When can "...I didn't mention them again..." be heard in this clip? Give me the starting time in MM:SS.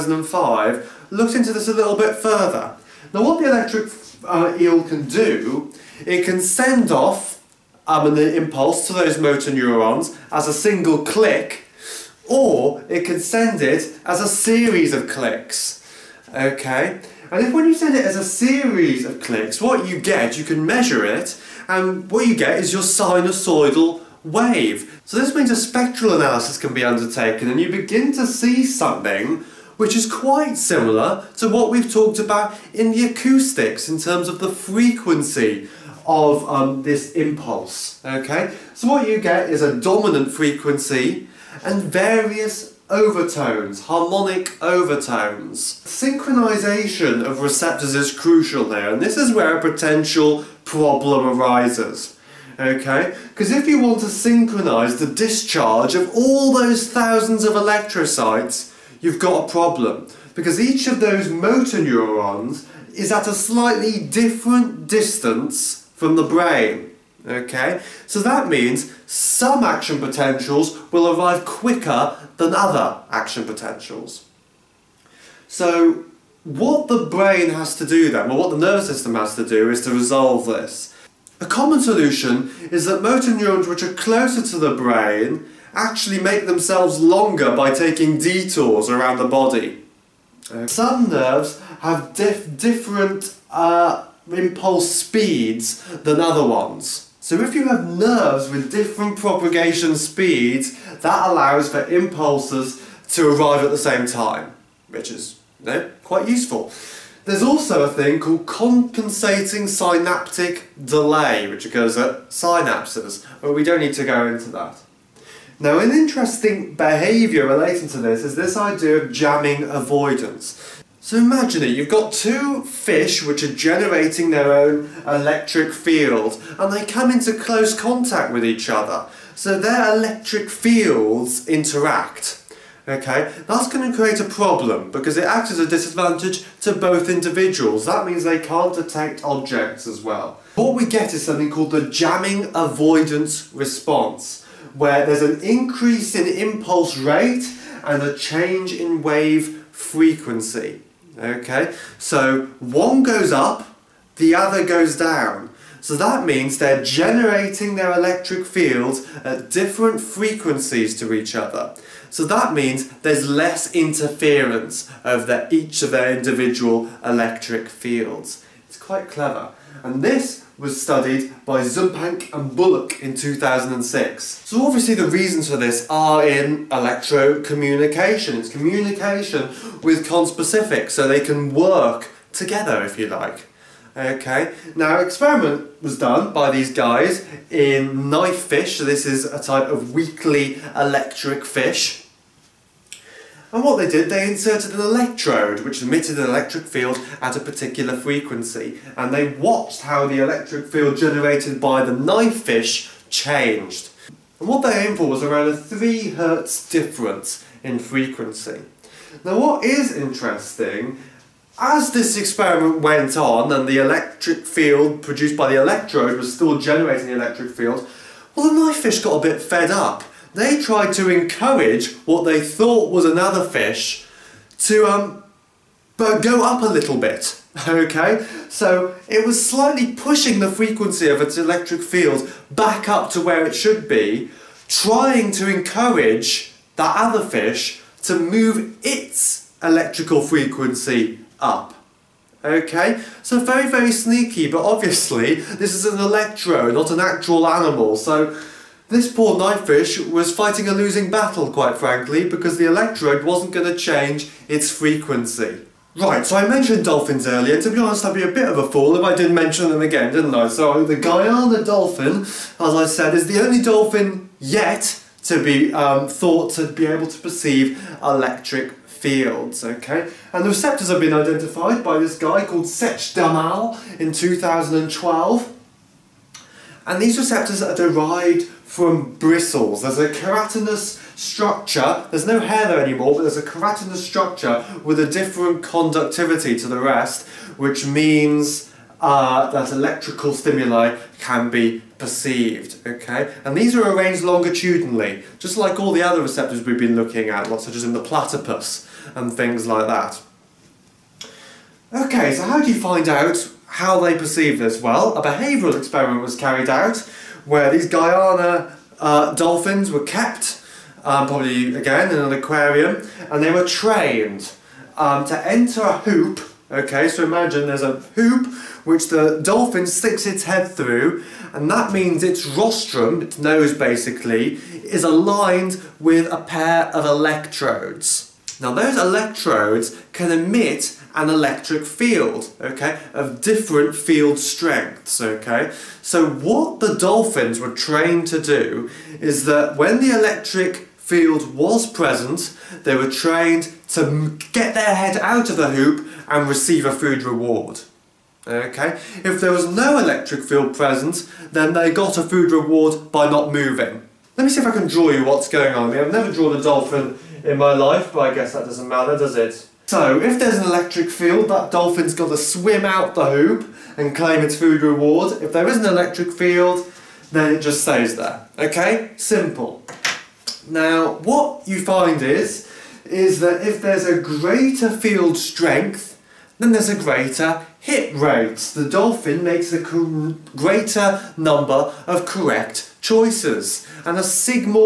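04:19.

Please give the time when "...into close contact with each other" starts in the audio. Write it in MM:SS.
02:07.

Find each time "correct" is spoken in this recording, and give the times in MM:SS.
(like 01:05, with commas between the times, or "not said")
06:22.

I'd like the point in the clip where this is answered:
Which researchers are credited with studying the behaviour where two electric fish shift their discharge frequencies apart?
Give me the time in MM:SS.
02:51.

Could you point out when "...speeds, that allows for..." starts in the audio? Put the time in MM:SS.
01:39.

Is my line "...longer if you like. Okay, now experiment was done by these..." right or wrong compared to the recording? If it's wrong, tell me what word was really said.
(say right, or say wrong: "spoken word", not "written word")
wrong: "together", not "longer".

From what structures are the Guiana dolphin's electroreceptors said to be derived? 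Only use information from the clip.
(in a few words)
Bristles.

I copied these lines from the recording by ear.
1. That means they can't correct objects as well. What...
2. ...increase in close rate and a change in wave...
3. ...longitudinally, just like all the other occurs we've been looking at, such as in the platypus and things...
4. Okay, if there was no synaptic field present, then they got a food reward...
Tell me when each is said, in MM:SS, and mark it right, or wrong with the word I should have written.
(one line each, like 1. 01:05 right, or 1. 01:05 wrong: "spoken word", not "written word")
1. 02:17 wrong: "detect", not "correct"
2. 02:25 wrong: "impulse", not "close"
3. 04:54 wrong: "receptors", not "occurs"
4. 05:48 wrong: "electric", not "synaptic".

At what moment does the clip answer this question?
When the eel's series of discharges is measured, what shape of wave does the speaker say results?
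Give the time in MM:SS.
00:22.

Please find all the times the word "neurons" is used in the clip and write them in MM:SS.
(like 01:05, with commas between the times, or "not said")
00:09, 01:01, 01:23.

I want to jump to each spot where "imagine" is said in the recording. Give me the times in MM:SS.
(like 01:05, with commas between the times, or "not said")
02:01, 05:17.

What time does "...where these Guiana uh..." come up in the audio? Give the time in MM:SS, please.
05:07.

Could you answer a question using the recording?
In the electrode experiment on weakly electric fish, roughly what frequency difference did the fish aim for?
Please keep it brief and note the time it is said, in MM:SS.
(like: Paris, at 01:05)
3 hertz, at 03:25.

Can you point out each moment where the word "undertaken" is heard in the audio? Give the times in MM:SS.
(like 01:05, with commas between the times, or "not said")
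00:26.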